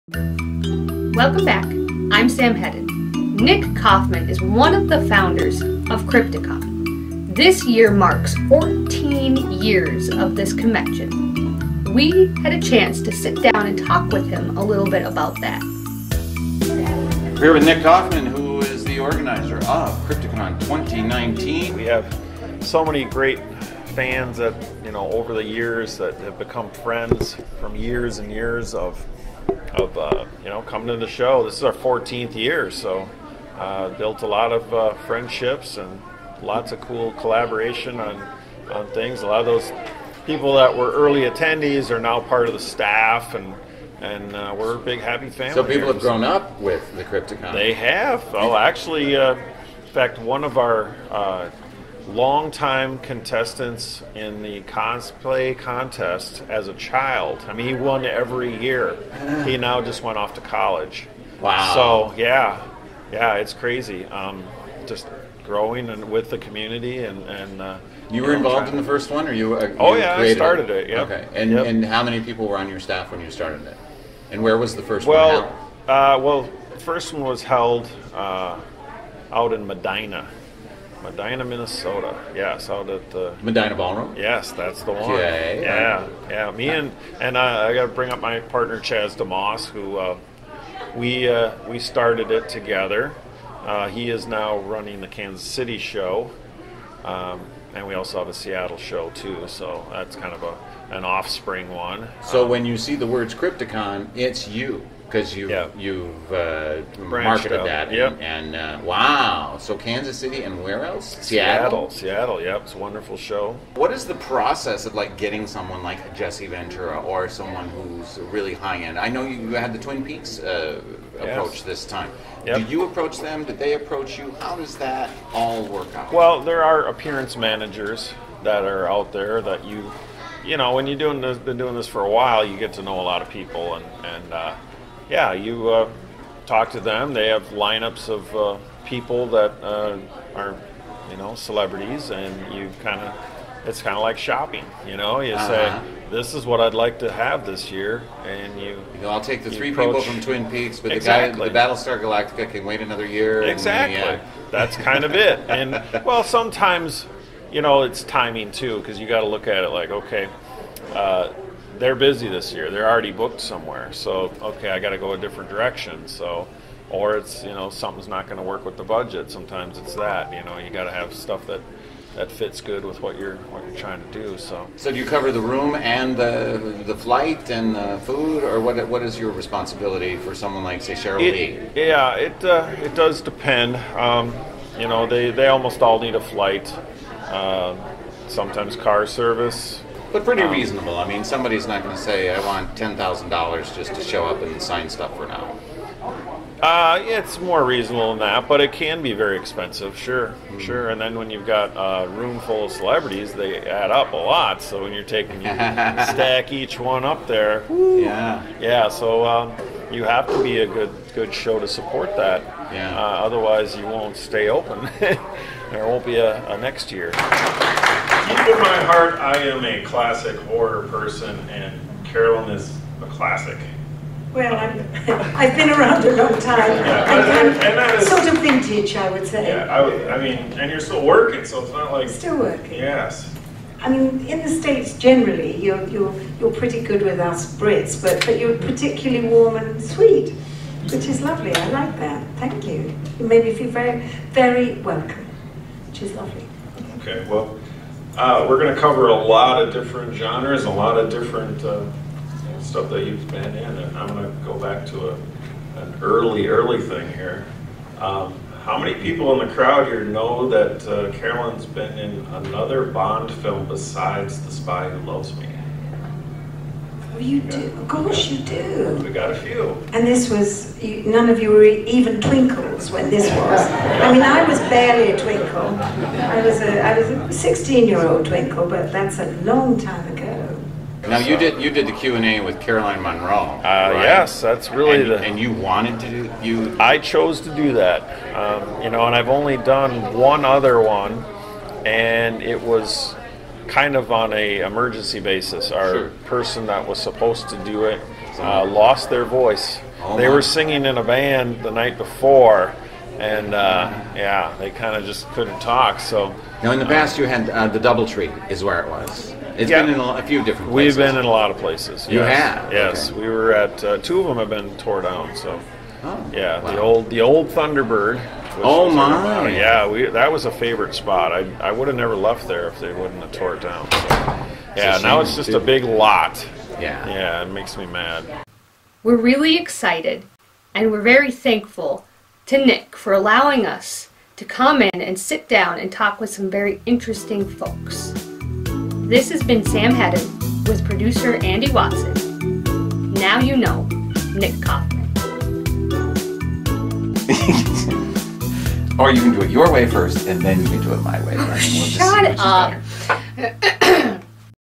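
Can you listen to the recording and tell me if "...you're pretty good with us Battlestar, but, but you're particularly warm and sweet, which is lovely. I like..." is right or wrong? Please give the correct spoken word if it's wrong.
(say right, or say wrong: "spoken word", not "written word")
wrong: "Brits", not "Battlestar".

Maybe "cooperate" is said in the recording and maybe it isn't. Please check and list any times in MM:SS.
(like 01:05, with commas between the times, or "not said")
not said.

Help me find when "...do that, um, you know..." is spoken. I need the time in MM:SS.
04:47.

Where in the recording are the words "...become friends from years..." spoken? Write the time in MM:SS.
00:26.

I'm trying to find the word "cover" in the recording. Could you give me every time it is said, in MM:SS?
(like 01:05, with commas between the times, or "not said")
02:55, 04:08.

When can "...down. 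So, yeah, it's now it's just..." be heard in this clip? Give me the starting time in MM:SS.
05:23.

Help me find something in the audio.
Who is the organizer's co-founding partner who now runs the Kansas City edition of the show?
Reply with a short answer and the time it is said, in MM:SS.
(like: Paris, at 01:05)
Chaz DeMoss, at 01:28.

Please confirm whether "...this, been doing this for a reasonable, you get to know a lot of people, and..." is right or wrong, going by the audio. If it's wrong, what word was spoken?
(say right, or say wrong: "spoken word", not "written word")
wrong: "while", not "reasonable".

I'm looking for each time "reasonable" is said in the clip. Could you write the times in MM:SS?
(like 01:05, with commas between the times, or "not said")
03:10, 03:17.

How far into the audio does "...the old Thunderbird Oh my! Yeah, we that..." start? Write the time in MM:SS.
05:17.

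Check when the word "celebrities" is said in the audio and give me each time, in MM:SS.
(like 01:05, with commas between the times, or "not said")
02:21, 03:22.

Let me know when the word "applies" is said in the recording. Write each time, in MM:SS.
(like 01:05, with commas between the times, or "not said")
not said.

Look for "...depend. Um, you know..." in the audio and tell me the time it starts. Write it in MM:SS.
03:03.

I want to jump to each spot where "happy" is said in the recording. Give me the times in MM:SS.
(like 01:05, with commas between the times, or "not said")
00:44.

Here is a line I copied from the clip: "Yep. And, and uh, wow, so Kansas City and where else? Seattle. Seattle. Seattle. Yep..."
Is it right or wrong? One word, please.
right.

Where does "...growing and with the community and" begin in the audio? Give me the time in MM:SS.
01:05.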